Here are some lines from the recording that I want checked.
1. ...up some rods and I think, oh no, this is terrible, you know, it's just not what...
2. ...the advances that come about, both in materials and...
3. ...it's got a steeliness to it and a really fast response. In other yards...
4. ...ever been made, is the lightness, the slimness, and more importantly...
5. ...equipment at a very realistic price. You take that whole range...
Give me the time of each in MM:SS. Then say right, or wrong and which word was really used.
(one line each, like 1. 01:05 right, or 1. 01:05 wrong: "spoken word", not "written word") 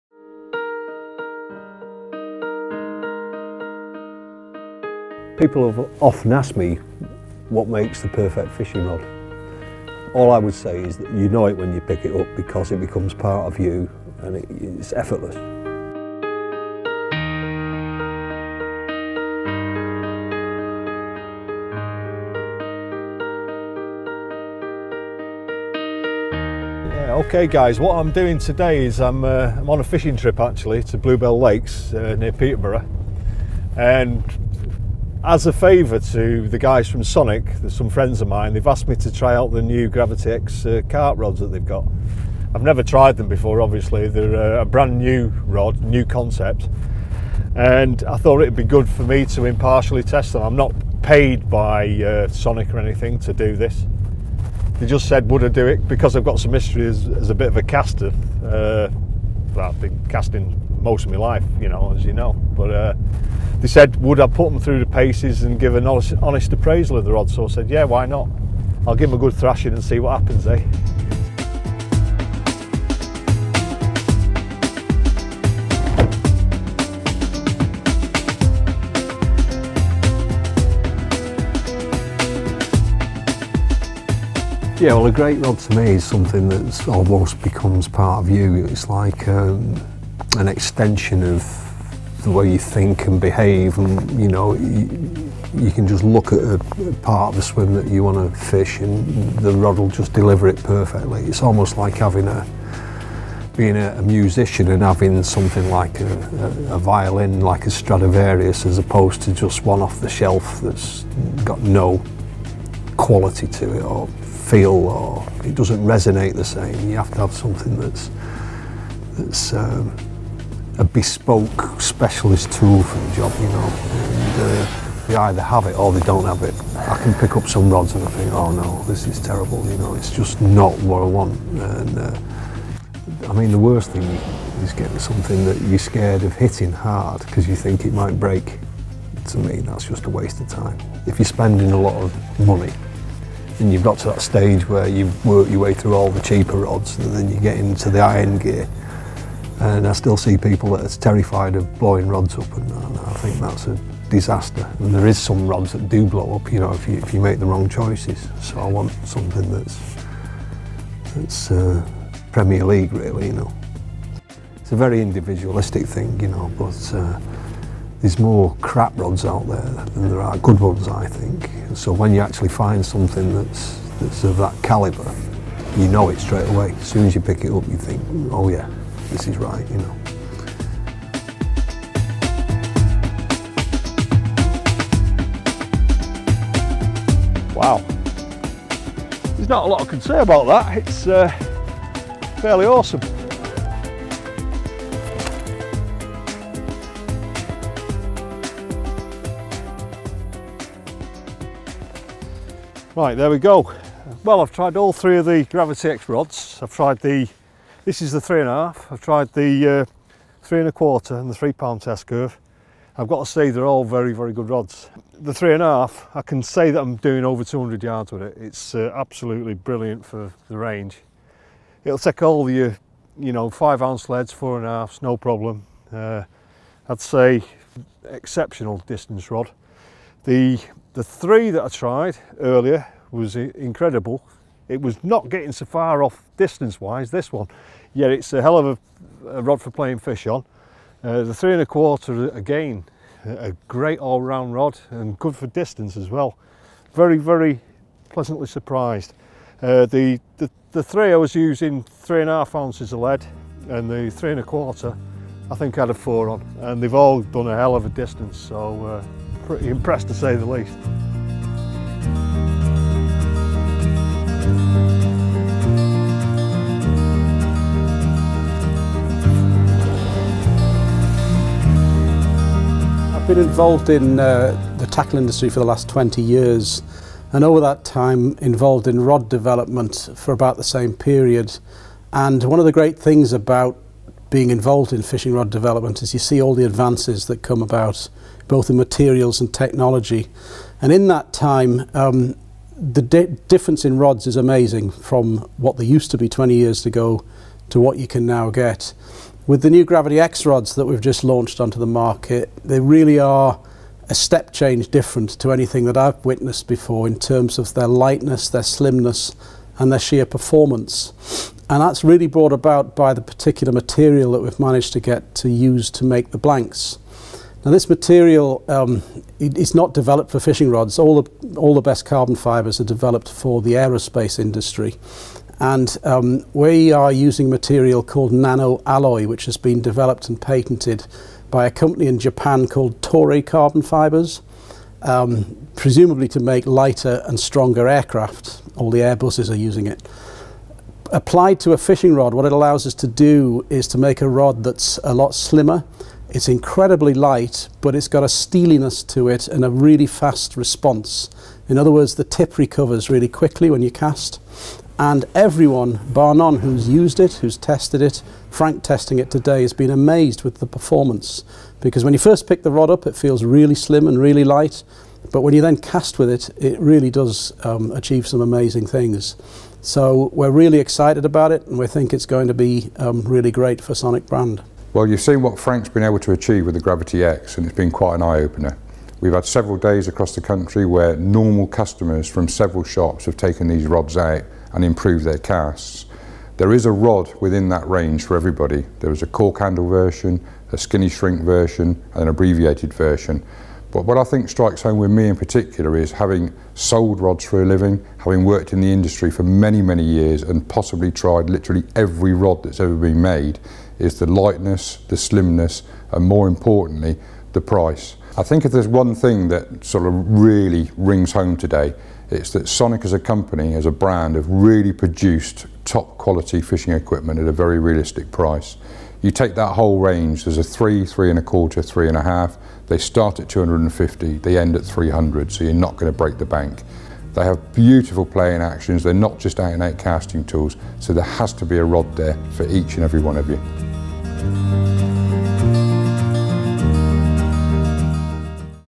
1. 02:07 right
2. 04:46 right
3. 05:47 wrong: "words", not "yards"
4. 06:42 right
5. 06:56 right.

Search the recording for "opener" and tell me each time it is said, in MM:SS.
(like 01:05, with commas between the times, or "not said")
06:18.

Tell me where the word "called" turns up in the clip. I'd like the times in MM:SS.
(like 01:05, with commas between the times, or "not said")
05:28, 05:32.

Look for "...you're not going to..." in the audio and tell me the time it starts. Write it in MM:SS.
07:05.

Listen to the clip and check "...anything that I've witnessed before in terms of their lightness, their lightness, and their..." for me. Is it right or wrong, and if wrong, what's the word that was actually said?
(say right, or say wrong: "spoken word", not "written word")
wrong: "slimness", not "lightness".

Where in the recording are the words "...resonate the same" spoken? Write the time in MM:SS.
01:55.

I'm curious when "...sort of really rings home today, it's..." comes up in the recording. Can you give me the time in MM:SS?
06:49.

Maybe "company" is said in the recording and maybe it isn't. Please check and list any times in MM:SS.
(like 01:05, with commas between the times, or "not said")
05:31, 06:53.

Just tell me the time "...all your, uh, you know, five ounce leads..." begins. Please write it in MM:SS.
03:42.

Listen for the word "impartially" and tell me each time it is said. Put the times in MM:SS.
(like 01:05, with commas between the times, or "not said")
00:49.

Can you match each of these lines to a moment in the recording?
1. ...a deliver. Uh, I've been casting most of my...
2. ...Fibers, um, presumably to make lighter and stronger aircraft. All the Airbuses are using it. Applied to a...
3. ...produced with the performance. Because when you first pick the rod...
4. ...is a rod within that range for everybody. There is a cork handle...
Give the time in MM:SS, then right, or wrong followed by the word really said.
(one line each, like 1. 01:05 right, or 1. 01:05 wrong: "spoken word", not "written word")
1. 00:57 wrong: "caster", not "deliver"
2. 05:33 right
3. 05:59 wrong: "amazed", not "produced"
4. 06:26 right.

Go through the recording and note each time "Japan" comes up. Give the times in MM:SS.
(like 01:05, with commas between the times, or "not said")
05:32.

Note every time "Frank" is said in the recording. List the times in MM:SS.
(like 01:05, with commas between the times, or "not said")
05:58, 06:15.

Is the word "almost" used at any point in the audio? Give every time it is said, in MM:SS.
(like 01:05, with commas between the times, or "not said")
01:26, 01:41.